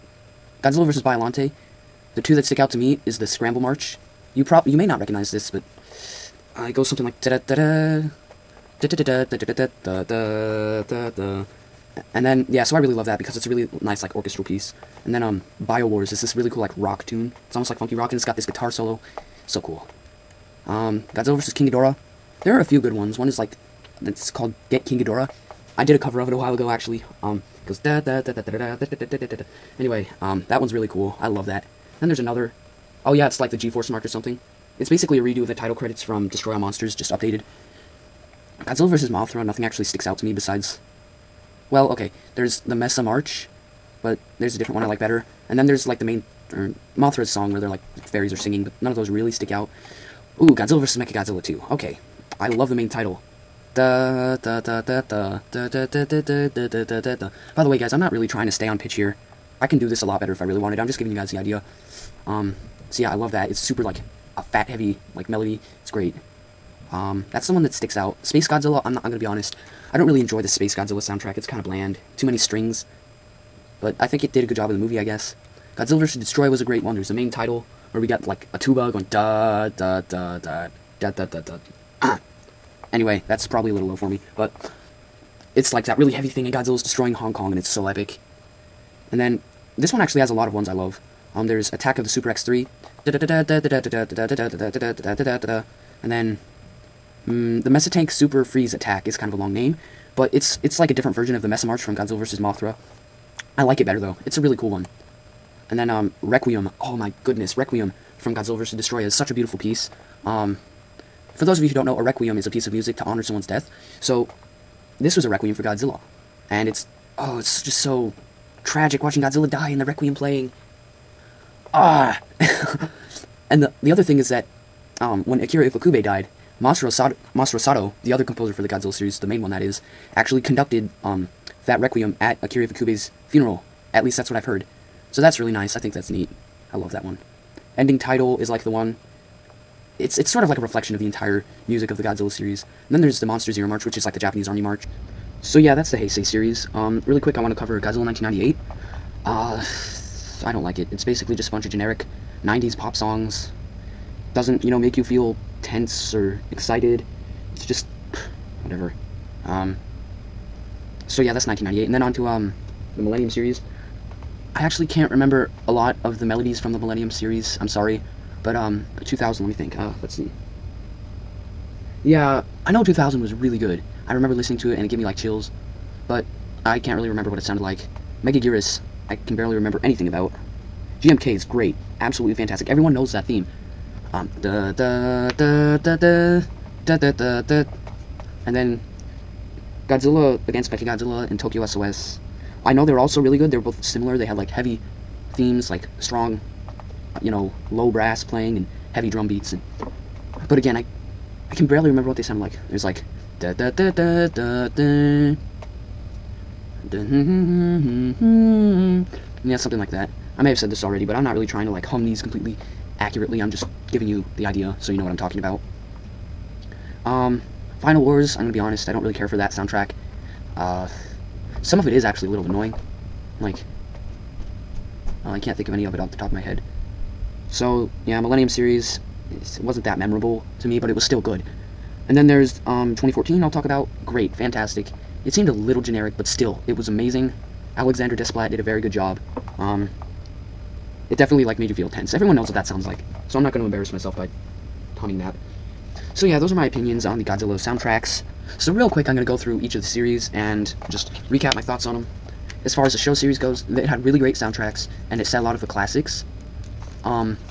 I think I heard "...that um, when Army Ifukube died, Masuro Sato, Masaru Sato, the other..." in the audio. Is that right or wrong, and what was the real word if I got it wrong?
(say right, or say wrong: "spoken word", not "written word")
wrong: "Akira", not "Army".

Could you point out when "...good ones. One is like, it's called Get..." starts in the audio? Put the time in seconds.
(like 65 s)
22 s.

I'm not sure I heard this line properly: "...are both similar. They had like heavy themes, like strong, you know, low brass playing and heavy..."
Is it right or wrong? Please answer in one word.
right.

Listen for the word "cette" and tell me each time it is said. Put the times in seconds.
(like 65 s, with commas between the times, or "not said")
not said.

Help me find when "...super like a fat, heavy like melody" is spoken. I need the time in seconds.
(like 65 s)
63 s.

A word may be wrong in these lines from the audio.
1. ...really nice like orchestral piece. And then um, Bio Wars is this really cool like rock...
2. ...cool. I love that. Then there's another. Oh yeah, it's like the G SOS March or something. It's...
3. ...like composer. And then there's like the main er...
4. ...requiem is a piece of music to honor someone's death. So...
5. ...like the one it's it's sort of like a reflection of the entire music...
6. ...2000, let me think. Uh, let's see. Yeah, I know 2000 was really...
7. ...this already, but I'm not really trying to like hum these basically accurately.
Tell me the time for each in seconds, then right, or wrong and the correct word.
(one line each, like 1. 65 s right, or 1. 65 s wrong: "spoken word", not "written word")
1. 13 s right
2. 30 s wrong: "Force", not "SOS"
3. 44 s wrong: "better", not "composer"
4. 112 s right
5. 138 s right
6. 169 s right
7. 210 s wrong: "completely", not "basically".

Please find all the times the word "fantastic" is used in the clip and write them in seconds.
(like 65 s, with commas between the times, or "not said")
182 s, 234 s.